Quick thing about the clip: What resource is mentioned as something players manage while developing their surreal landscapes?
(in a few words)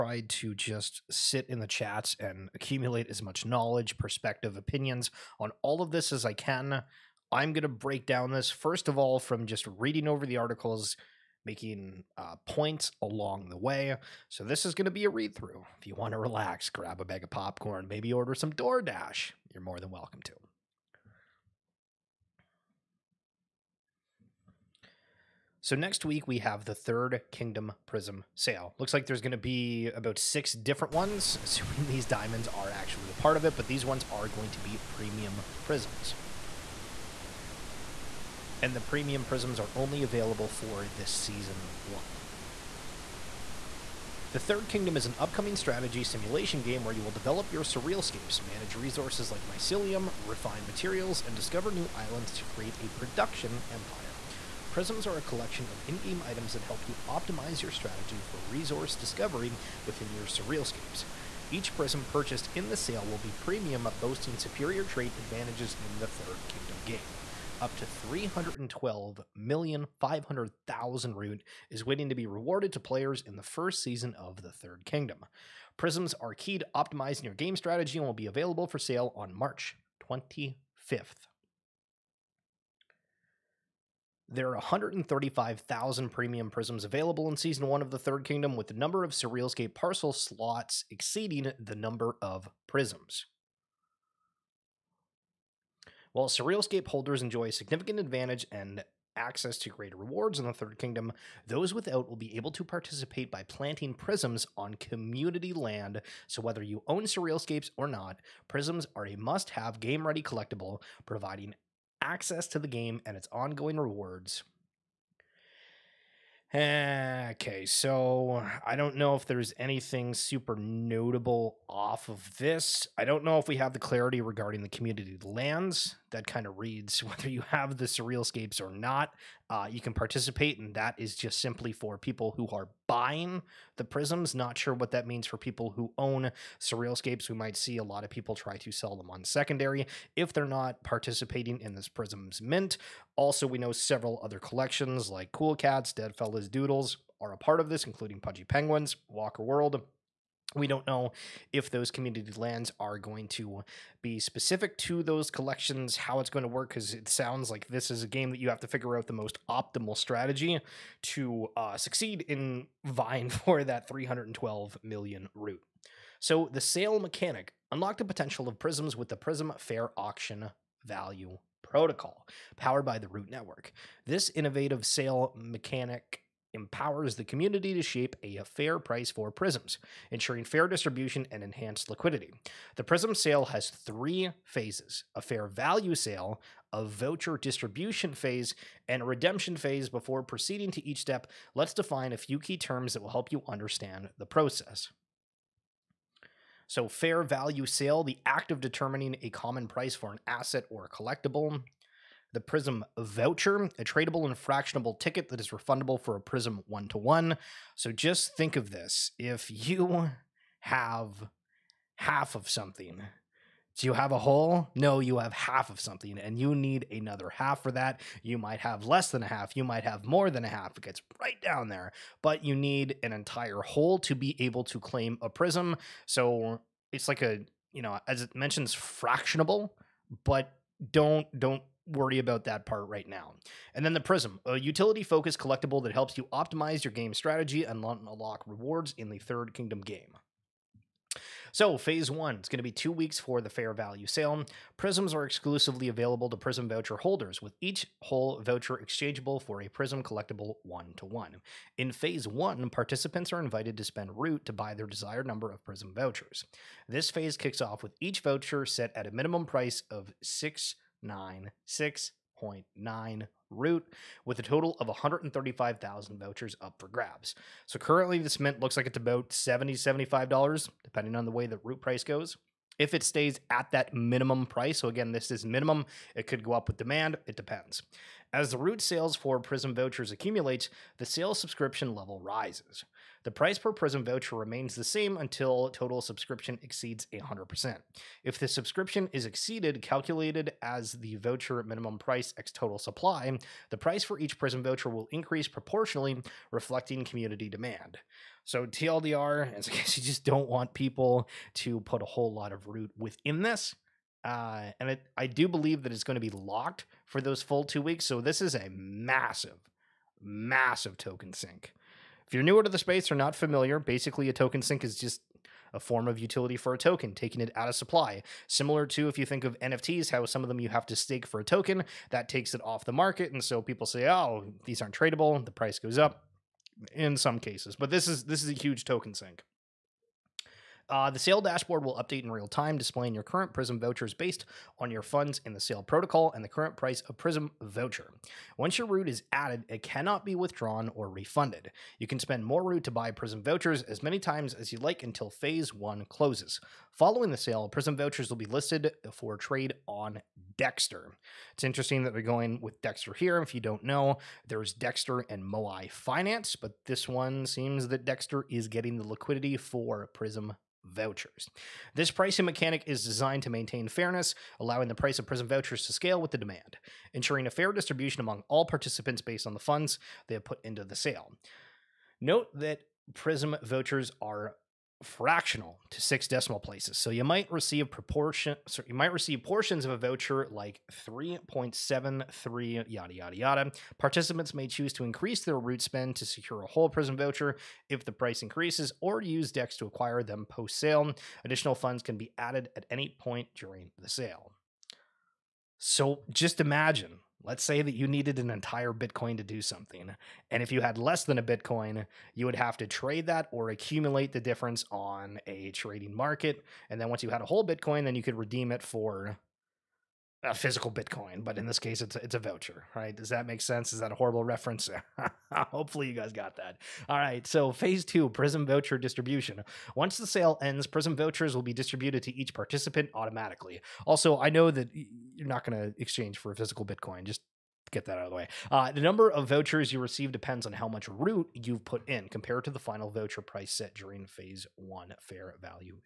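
mycelium.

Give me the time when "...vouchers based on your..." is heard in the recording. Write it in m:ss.
5:33.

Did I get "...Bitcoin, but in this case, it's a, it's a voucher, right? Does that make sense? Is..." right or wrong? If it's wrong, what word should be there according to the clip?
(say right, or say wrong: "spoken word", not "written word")
right.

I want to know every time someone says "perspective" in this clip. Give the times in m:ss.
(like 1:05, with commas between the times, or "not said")
0:03.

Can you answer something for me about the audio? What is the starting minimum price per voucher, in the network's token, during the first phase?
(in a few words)
6.9 root.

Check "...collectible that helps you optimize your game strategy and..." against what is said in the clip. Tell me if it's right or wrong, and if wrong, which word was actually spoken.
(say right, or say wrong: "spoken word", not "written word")
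right.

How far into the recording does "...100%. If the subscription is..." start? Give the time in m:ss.
4:47.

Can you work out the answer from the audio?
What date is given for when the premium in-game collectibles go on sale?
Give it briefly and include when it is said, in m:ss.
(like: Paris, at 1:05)
March 25th, at 1:19.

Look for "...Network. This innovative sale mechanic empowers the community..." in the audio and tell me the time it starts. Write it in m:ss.
2:53.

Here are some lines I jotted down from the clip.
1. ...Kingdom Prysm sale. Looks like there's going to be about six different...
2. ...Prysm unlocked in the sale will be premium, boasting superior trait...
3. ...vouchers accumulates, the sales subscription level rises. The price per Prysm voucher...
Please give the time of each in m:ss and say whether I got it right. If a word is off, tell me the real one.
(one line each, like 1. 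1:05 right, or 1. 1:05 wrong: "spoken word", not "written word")
1. 0:27 right
2. 1:01 wrong: "purchased", not "unlocked"
3. 4:39 right.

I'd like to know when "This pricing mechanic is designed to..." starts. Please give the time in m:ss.
6:01.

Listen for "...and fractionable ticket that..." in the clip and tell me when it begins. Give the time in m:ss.
3:24.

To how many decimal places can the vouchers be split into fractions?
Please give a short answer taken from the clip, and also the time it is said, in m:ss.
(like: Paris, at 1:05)
6, at 6:16.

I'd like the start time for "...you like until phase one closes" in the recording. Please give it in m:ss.
5:44.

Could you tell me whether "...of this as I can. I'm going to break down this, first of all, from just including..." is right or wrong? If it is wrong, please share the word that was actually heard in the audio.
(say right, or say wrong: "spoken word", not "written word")
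wrong: "reading", not "including".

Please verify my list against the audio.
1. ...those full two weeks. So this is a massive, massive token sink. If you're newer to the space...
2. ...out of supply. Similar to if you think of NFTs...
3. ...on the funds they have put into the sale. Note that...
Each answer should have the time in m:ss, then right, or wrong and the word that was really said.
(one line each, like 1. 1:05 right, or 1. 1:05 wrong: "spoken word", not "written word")
1. 5:07 right
2. 5:17 right
3. 6:09 right.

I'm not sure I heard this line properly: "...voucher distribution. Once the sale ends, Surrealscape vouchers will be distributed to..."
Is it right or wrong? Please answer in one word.
wrong.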